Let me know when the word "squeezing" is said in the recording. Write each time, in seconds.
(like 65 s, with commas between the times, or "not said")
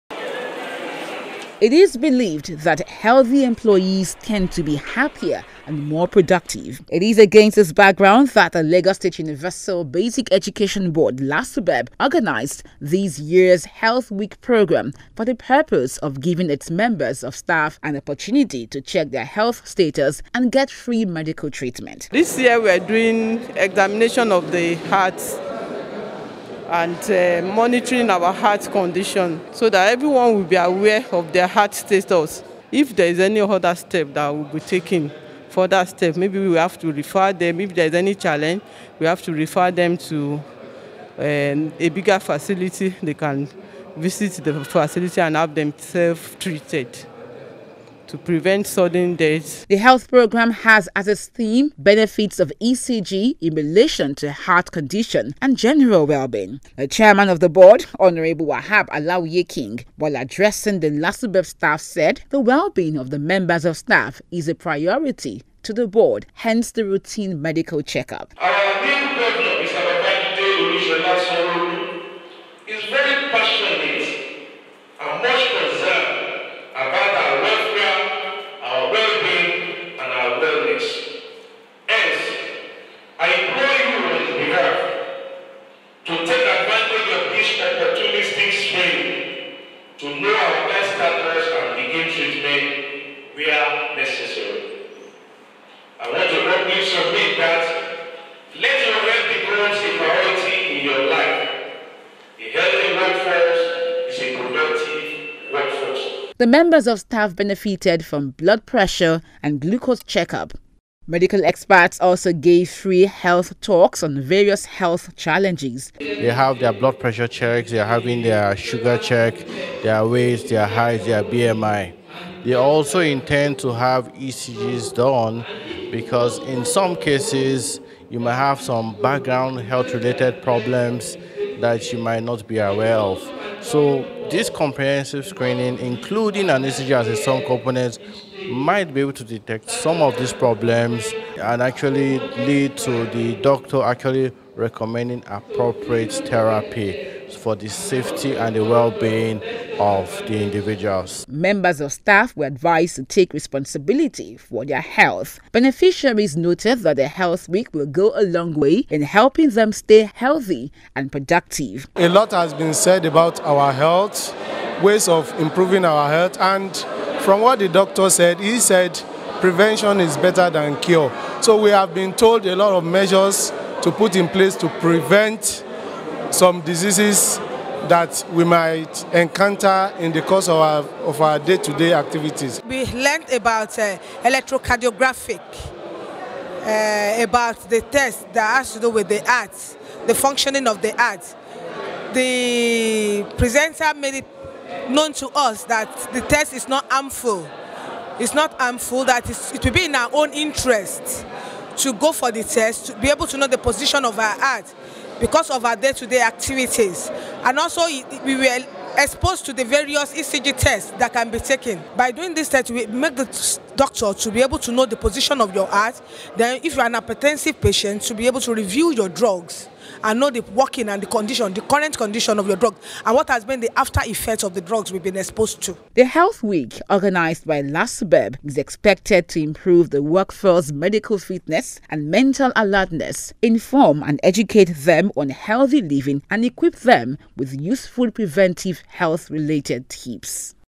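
not said.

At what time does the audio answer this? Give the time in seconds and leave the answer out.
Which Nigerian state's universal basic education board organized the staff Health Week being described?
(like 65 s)
8 s.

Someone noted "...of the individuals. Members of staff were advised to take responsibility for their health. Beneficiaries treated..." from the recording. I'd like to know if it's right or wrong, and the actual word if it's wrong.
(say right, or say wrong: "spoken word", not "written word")
wrong: "noted", not "treated".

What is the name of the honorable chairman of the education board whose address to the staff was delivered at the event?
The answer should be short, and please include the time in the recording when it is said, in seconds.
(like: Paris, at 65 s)
Wahab Alawiye-King, at 58 s.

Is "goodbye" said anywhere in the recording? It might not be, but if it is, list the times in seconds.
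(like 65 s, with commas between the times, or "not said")
not said.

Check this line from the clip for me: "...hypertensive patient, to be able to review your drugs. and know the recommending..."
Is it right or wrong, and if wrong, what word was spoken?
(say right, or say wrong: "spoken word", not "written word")
wrong: "working", not "recommending".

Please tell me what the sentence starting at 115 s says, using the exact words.
They have their blood pressure checks, they are having their sugar check, their weight, their height, their BMI.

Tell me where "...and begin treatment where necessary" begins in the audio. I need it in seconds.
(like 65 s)
91 s.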